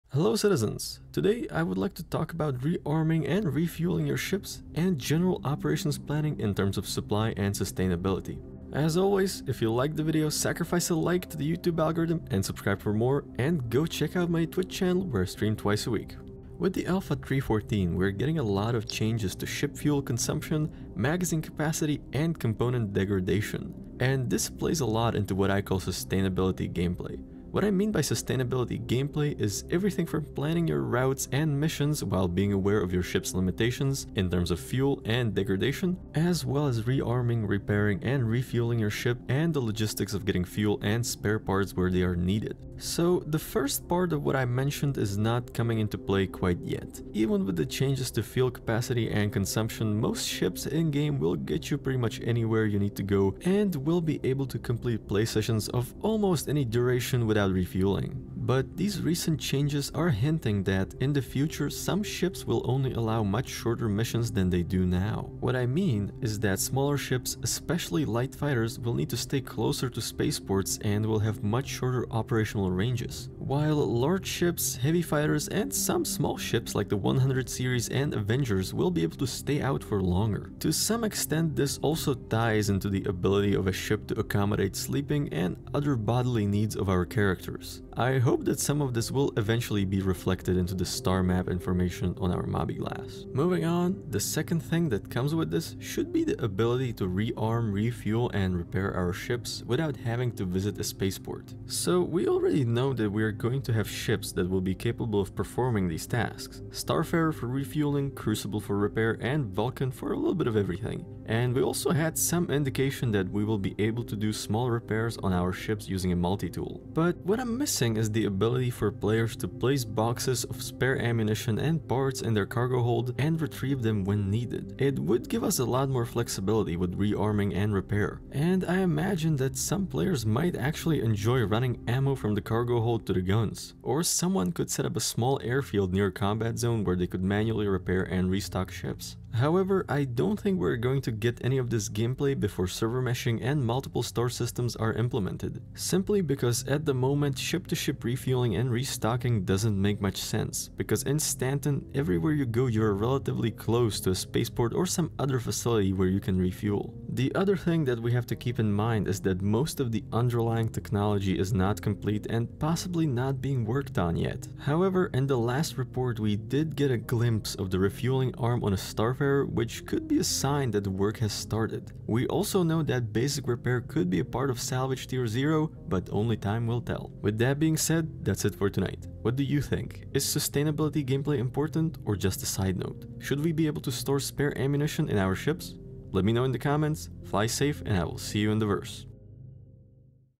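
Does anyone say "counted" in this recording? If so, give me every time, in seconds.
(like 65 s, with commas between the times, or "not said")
not said.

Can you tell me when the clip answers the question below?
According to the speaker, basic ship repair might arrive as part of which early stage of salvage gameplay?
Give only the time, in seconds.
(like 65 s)
174 s.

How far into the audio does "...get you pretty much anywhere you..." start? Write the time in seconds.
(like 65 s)
51 s.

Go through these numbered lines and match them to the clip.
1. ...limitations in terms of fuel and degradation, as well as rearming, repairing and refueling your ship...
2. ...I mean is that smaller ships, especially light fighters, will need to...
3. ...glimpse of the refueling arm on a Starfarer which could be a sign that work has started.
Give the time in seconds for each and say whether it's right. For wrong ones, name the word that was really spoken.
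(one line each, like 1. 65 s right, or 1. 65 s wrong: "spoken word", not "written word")
1. 33 s right
2. 65 s right
3. 166 s right.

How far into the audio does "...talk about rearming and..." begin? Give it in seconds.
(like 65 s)
2 s.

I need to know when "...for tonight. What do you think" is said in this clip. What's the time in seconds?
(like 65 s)
178 s.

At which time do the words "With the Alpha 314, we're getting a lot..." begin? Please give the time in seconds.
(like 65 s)
16 s.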